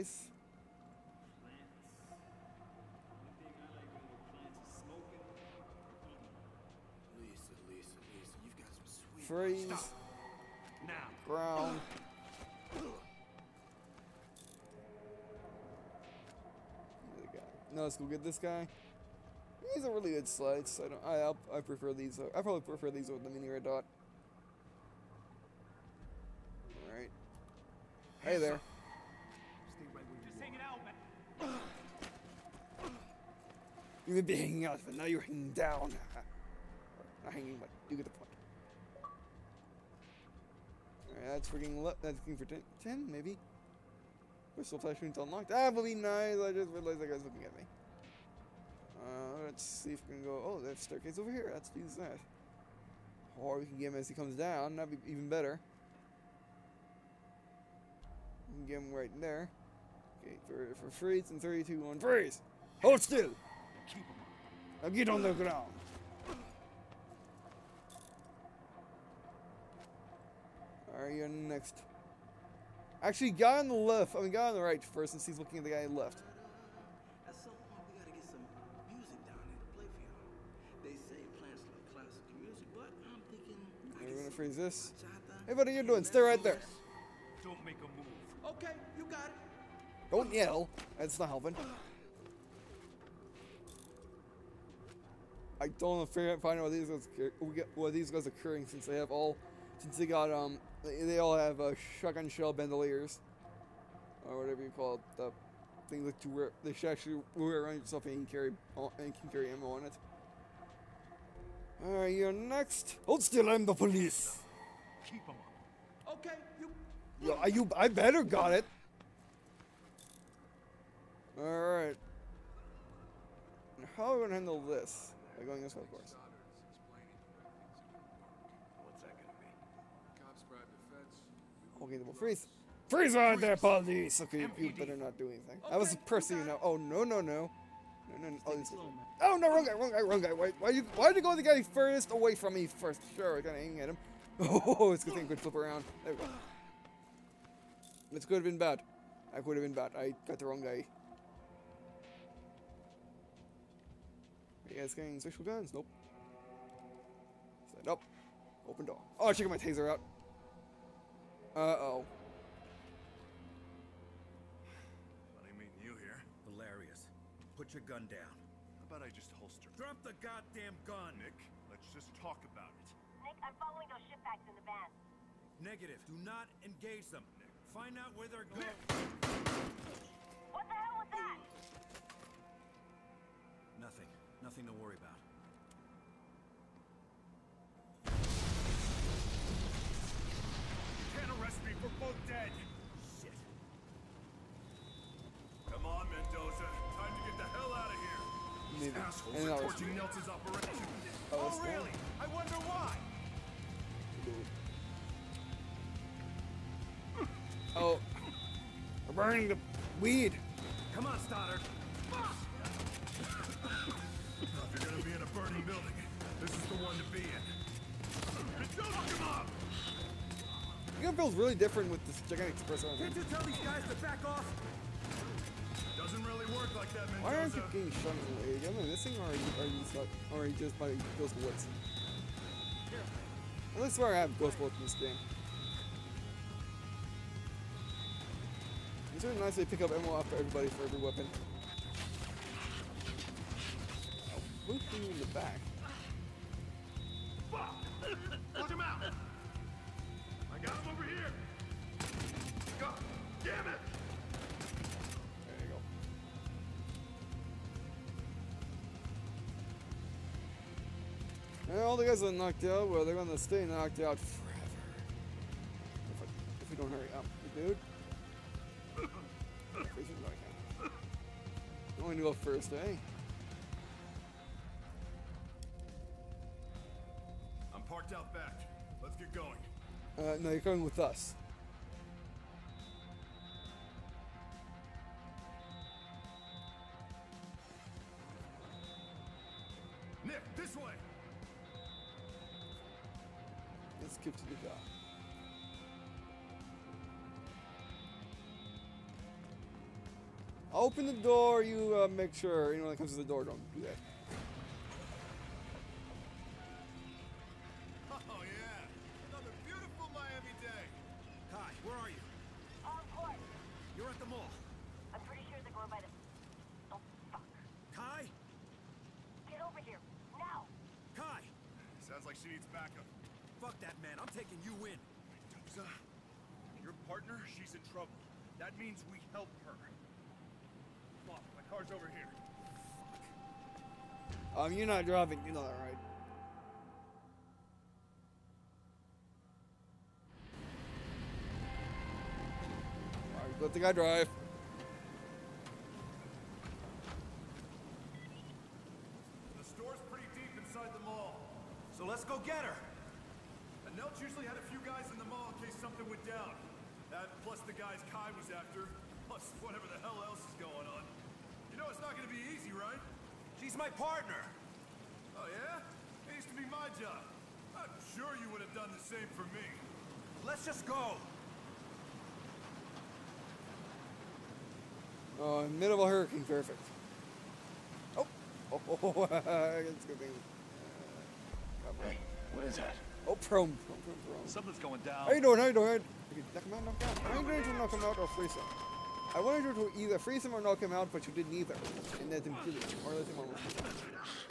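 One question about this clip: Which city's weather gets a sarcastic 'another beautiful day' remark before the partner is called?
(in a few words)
Miami.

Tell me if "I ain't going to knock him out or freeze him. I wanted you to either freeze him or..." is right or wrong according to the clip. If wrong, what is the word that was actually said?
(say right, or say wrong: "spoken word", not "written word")
right.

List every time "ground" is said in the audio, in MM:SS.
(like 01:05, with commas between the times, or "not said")
00:11, 01:05.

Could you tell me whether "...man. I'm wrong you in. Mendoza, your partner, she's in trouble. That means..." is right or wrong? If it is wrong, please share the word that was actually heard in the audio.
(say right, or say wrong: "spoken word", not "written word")
wrong: "taking", not "wrong".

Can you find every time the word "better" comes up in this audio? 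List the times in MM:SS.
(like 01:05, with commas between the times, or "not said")
00:55, 01:57, 02:14.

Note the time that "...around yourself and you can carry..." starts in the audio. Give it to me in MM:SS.
01:47.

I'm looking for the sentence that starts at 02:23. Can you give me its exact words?
Sure, I gotta aim at him.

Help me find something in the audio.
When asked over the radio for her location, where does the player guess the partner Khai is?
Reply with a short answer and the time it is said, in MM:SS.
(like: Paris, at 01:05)
the mall, at 05:14.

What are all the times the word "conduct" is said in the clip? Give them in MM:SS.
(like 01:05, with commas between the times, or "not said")
not said.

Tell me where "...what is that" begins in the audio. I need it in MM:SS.
06:22.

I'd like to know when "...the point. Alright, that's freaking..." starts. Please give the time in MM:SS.
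00:38.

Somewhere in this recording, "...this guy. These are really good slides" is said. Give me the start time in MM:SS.
00:18.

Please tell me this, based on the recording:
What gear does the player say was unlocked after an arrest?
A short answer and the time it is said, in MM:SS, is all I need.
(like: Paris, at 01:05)
Whistle, at 00:44.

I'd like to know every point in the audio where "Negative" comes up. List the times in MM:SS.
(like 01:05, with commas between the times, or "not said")
02:55.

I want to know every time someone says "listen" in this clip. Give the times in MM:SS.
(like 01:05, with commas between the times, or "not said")
not said.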